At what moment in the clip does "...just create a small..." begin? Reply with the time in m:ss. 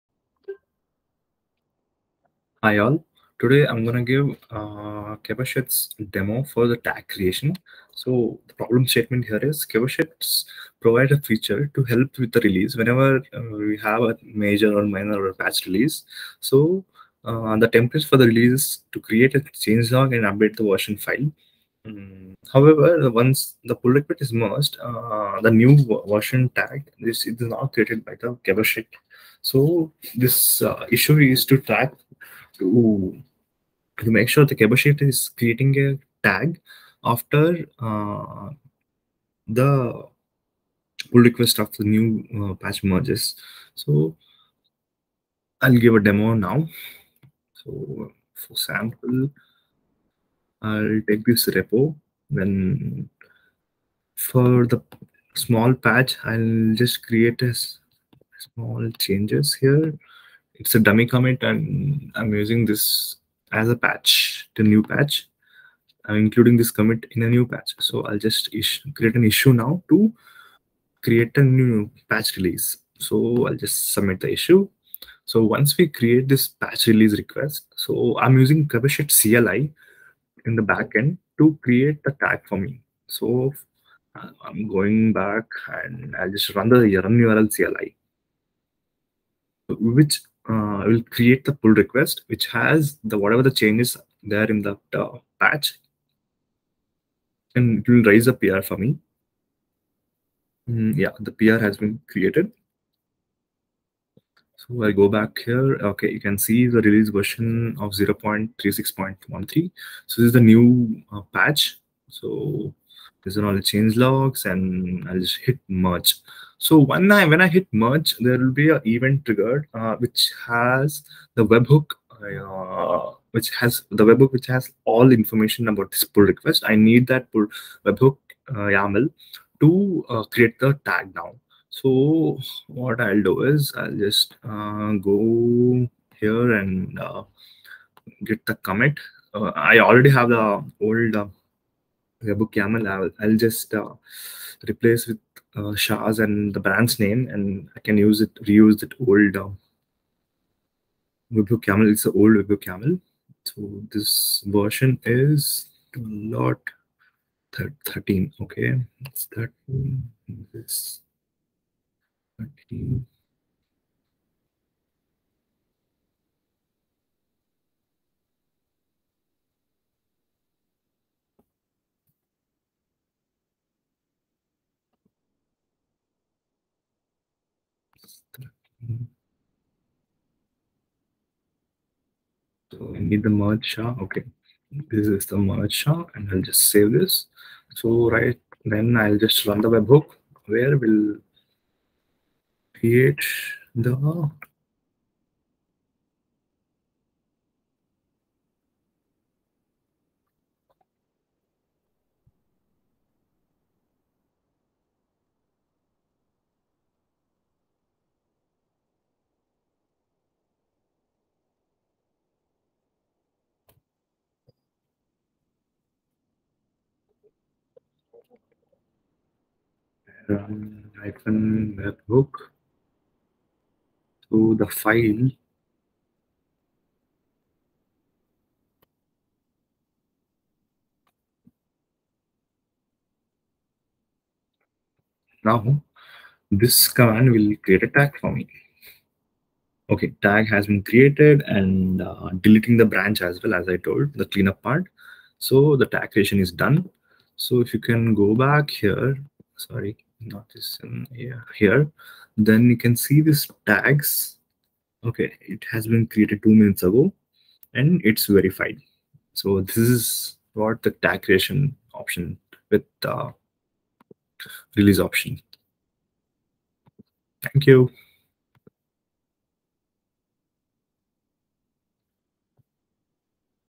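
0:56.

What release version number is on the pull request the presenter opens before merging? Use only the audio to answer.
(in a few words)
0.36.13.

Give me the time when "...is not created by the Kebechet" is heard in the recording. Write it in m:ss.
0:27.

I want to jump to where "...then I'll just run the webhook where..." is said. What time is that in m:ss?
3:08.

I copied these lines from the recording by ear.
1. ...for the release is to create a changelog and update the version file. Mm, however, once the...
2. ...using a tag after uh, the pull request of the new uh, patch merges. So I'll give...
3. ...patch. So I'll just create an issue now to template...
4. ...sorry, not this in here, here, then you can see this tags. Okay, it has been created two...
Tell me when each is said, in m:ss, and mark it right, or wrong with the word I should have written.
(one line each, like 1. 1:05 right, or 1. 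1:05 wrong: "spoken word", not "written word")
1. 0:18 right
2. 0:35 wrong: "creating", not "using"
3. 1:07 wrong: "create", not "template"
4. 4:09 right.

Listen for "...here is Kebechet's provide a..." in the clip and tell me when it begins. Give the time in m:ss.
0:09.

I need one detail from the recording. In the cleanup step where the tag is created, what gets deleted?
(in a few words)
the branch.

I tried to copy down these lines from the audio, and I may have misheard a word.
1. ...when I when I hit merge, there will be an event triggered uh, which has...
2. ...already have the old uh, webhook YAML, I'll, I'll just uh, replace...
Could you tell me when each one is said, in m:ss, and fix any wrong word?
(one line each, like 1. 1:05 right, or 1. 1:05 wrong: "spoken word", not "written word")
1. 1:56 right
2. 2:19 right.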